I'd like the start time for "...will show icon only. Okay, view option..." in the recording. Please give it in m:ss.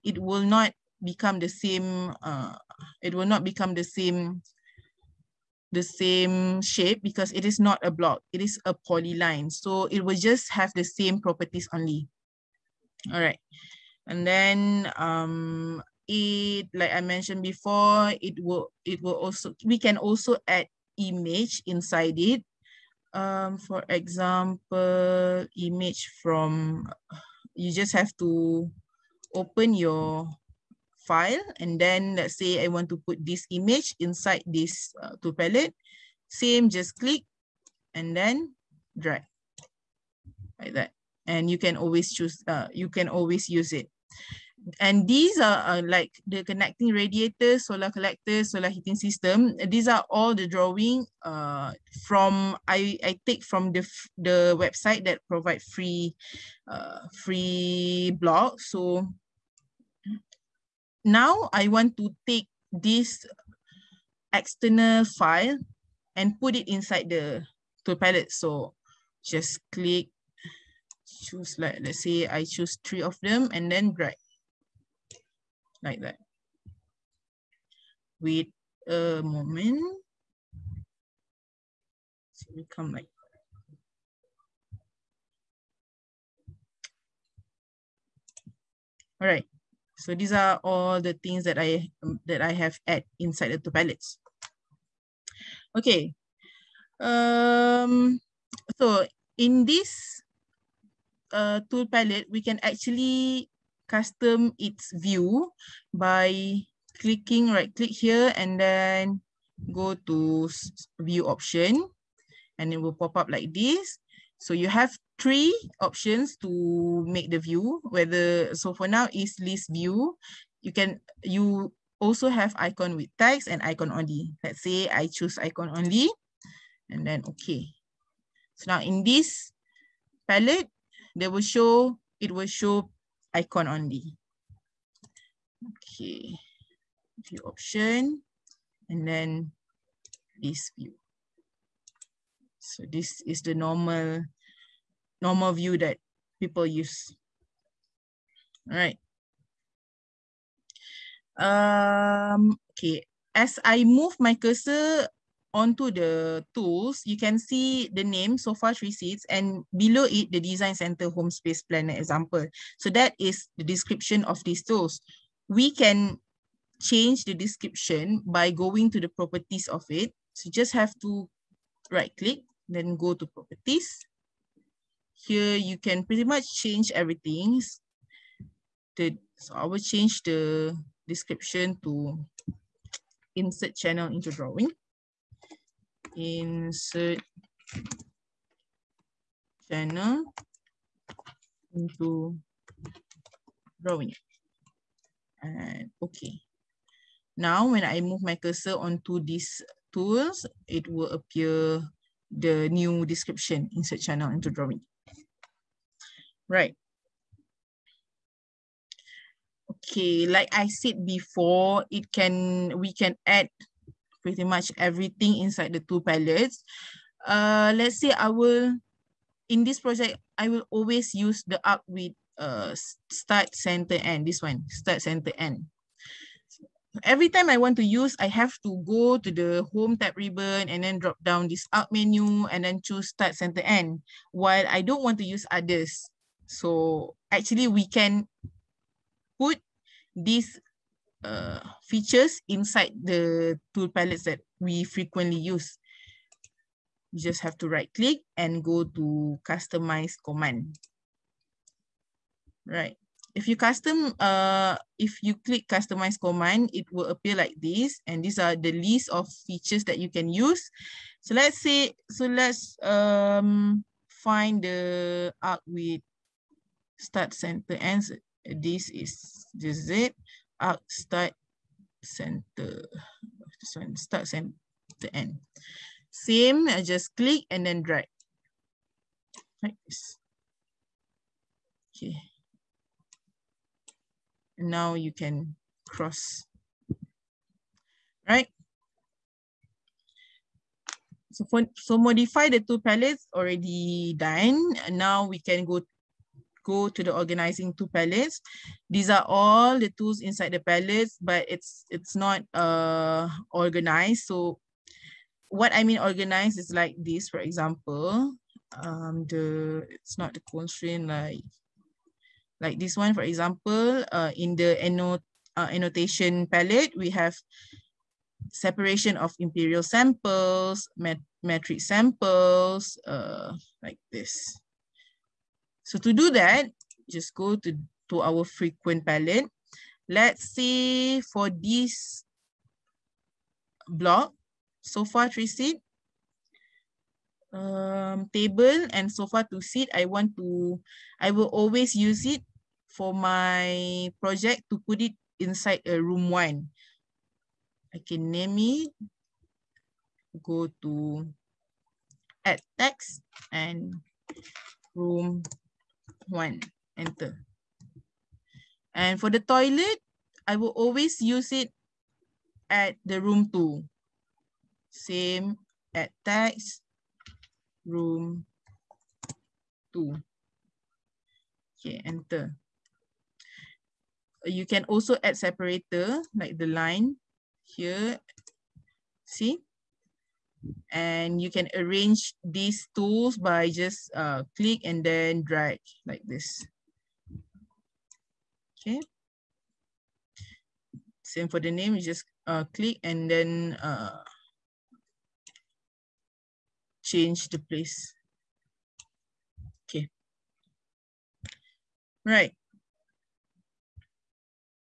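2:12.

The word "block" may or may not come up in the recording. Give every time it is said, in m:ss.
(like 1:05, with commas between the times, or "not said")
0:07, 0:58, 5:33.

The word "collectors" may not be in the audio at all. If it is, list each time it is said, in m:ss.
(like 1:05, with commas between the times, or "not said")
0:47.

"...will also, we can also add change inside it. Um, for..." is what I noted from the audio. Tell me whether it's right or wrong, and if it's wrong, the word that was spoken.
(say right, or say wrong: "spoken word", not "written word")
wrong: "image", not "change".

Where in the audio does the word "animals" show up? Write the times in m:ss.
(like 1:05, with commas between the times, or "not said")
not said.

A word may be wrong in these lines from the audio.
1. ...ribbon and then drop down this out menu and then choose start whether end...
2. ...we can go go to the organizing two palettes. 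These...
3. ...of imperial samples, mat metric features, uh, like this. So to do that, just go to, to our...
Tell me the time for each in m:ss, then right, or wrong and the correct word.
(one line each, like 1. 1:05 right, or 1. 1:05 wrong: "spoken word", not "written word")
1. 3:50 wrong: "center", not "whether"
2. 4:55 right
3. 5:19 wrong: "samples", not "features".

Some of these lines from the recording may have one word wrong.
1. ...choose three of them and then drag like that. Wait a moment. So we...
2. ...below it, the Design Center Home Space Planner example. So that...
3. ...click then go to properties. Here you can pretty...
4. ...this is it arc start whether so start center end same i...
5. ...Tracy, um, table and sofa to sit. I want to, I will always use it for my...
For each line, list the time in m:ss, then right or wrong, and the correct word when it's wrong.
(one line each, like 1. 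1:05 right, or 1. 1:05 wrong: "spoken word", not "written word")
1. 1:12 right
2. 2:39 right
3. 2:52 right
4. 4:29 wrong: "center", not "whether"
5. 5:35 right.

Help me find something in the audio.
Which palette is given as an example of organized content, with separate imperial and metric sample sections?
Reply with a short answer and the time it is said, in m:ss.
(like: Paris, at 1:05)
Annotation palette, at 5:15.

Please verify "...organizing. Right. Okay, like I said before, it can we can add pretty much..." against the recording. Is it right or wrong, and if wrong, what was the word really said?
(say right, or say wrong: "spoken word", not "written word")
wrong: "drawing", not "organizing".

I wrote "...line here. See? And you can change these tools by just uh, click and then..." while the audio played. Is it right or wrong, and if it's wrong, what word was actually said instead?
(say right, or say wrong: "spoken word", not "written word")
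wrong: "arrange", not "change".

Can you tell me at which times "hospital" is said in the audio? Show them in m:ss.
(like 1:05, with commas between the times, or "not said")
not said.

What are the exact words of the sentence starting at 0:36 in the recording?
Same, just click and then drag like that.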